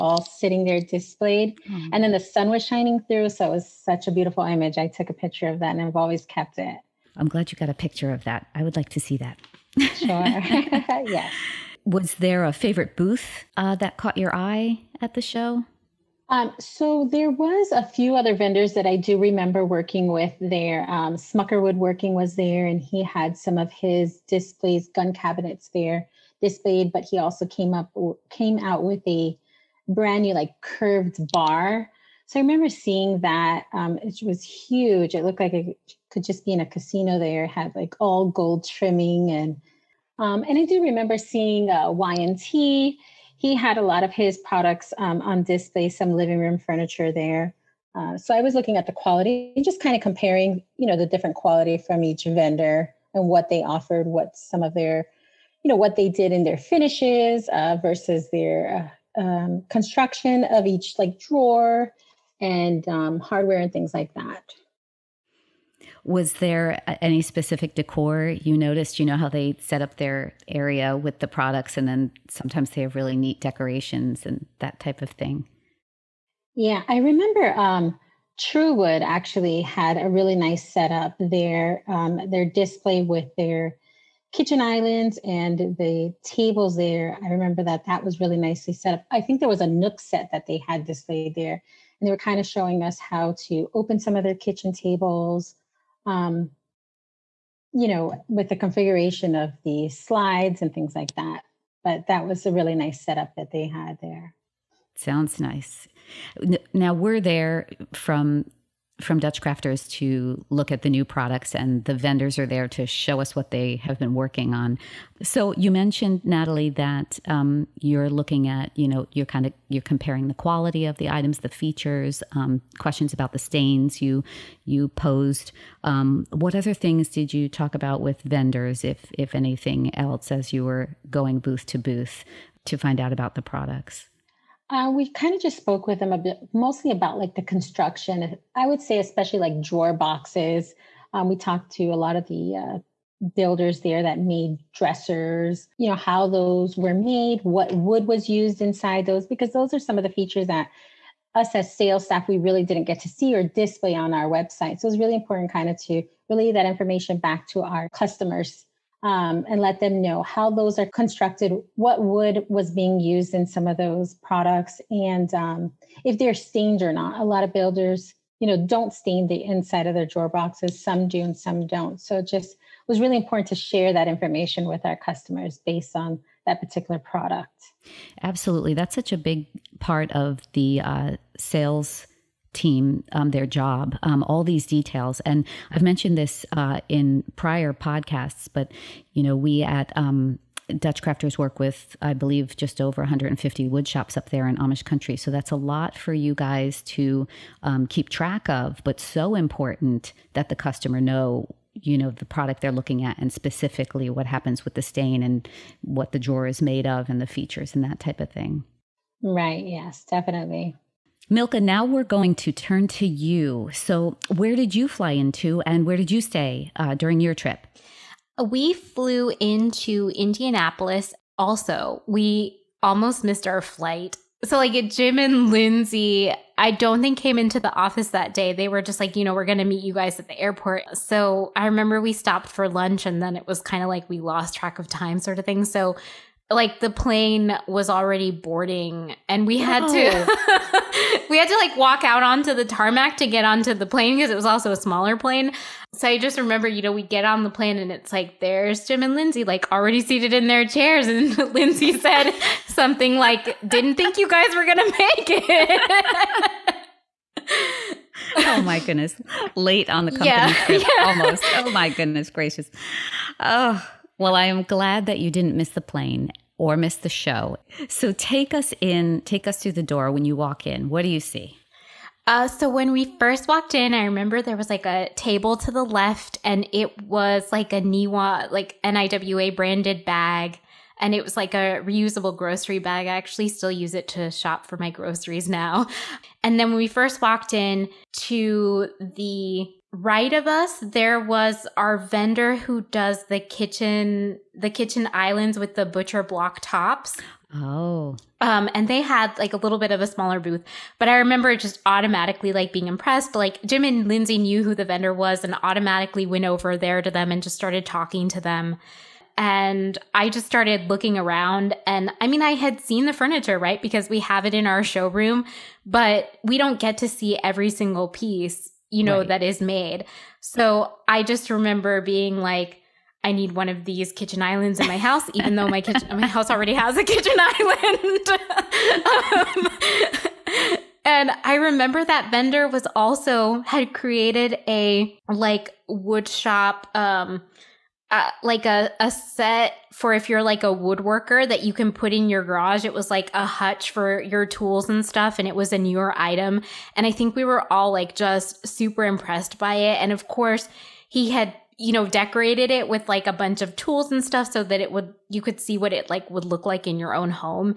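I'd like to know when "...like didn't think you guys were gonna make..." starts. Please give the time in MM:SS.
04:13.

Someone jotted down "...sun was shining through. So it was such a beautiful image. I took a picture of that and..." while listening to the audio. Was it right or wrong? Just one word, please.
right.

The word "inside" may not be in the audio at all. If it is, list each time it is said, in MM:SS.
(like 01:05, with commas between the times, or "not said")
02:28, 02:49.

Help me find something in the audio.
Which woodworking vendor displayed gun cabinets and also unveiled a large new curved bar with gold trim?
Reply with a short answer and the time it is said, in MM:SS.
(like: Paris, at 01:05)
Smucker Woodworking, at 00:21.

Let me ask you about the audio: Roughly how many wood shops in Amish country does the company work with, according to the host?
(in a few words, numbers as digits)
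just over 150.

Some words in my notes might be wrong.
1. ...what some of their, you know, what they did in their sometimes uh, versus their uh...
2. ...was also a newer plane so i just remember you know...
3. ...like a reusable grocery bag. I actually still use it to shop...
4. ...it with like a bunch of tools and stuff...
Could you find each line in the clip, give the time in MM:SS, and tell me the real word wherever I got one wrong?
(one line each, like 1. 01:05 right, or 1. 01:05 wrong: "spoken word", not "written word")
1. 00:54 wrong: "finishes", not "sometimes"
2. 04:04 wrong: "smaller", not "newer"
3. 04:41 right
4. 05:52 right.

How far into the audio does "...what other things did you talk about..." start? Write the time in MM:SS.
02:06.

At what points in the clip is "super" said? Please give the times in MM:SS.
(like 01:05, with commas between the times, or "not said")
05:48.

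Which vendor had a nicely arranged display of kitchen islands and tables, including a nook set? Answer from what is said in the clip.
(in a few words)
Truewood.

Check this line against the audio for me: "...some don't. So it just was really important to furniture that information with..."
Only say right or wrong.
wrong.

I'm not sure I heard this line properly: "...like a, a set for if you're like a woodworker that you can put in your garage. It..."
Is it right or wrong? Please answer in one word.
right.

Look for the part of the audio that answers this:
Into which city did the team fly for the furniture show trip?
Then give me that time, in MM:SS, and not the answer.
03:40.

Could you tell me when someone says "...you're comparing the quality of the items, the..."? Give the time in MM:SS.
01:59.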